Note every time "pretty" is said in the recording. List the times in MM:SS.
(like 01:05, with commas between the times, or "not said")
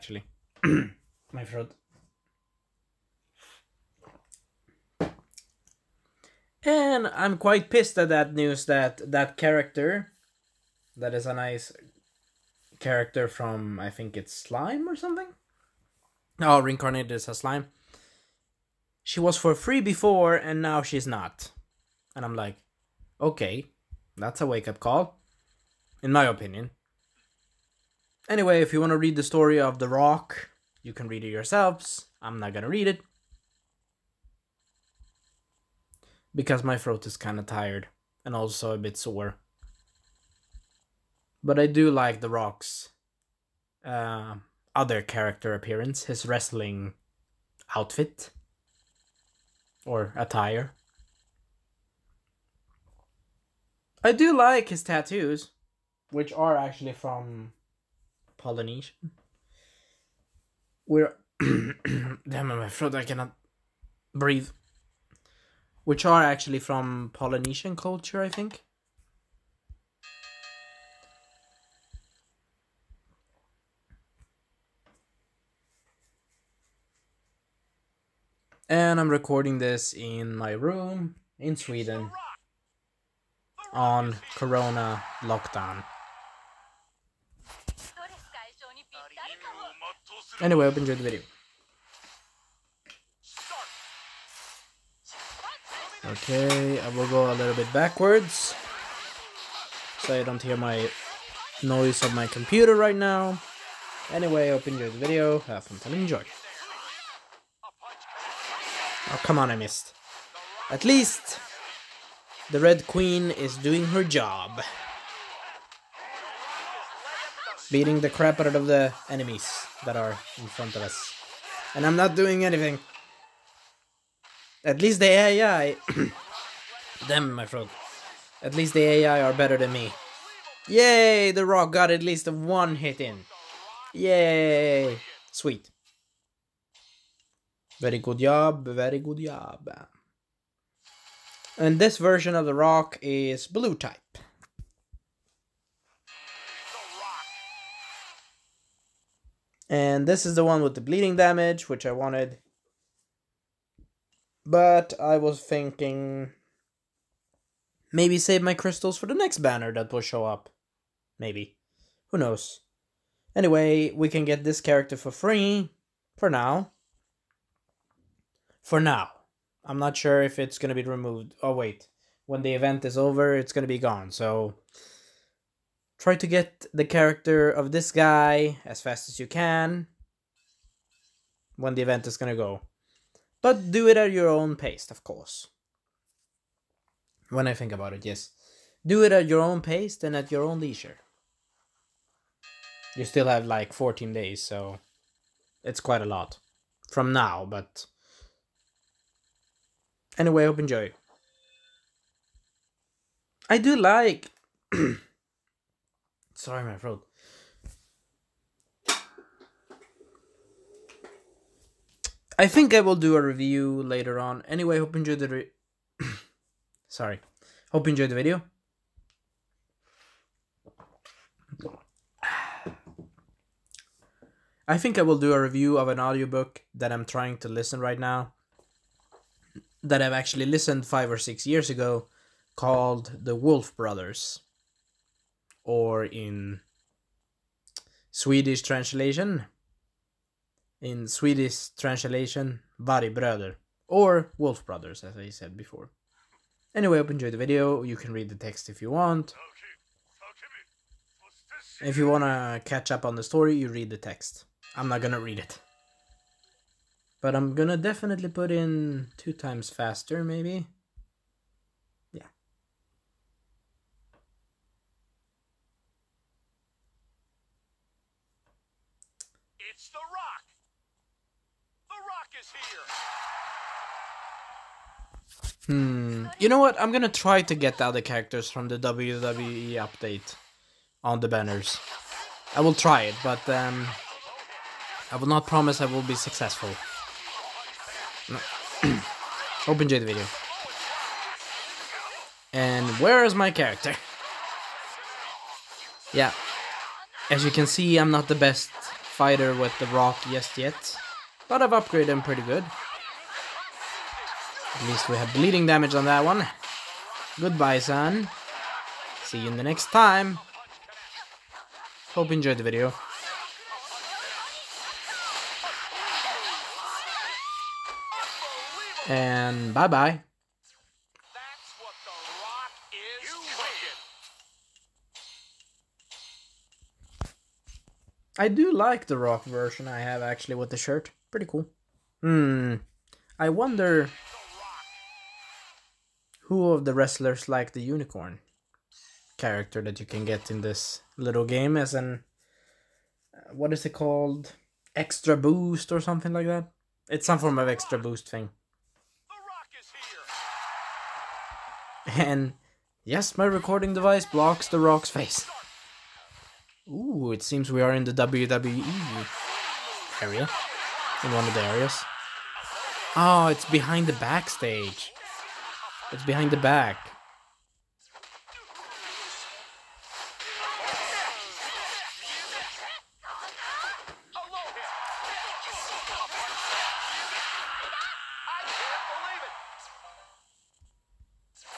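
05:02, 05:31.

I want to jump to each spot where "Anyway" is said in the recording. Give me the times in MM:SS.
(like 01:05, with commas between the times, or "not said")
00:28, 01:30, 01:44, 02:43, 03:20, 03:34, 04:06.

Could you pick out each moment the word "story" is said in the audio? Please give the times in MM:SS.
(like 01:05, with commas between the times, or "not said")
00:29, 04:13.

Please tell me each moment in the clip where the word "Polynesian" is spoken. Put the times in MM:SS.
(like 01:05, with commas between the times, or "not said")
00:58, 01:07.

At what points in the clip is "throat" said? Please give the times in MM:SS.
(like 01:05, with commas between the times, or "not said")
00:01, 00:36, 01:02, 03:26.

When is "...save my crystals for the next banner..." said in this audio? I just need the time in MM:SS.
02:38.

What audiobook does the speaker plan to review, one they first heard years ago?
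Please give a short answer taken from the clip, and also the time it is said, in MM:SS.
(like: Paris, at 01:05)
The Wolf Brothers, at 03:53.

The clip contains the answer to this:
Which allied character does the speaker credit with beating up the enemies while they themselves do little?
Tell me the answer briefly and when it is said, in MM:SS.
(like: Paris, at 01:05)
The Red Queen, at 01:52.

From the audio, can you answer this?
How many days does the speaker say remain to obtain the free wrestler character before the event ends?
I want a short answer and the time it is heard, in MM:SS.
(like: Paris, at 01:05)
14, at 03:13.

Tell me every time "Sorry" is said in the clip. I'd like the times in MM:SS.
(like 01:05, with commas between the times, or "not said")
03:26, 03:36.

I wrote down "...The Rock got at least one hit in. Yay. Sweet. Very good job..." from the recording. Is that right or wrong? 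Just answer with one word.
right.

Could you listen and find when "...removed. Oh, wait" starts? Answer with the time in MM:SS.
02:50.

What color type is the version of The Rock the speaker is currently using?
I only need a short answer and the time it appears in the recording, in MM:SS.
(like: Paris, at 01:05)
Blue, at 02:23.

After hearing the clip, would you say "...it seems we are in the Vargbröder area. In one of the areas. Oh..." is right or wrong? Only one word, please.
wrong.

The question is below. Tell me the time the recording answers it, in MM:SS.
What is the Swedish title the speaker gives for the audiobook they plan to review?
04:02.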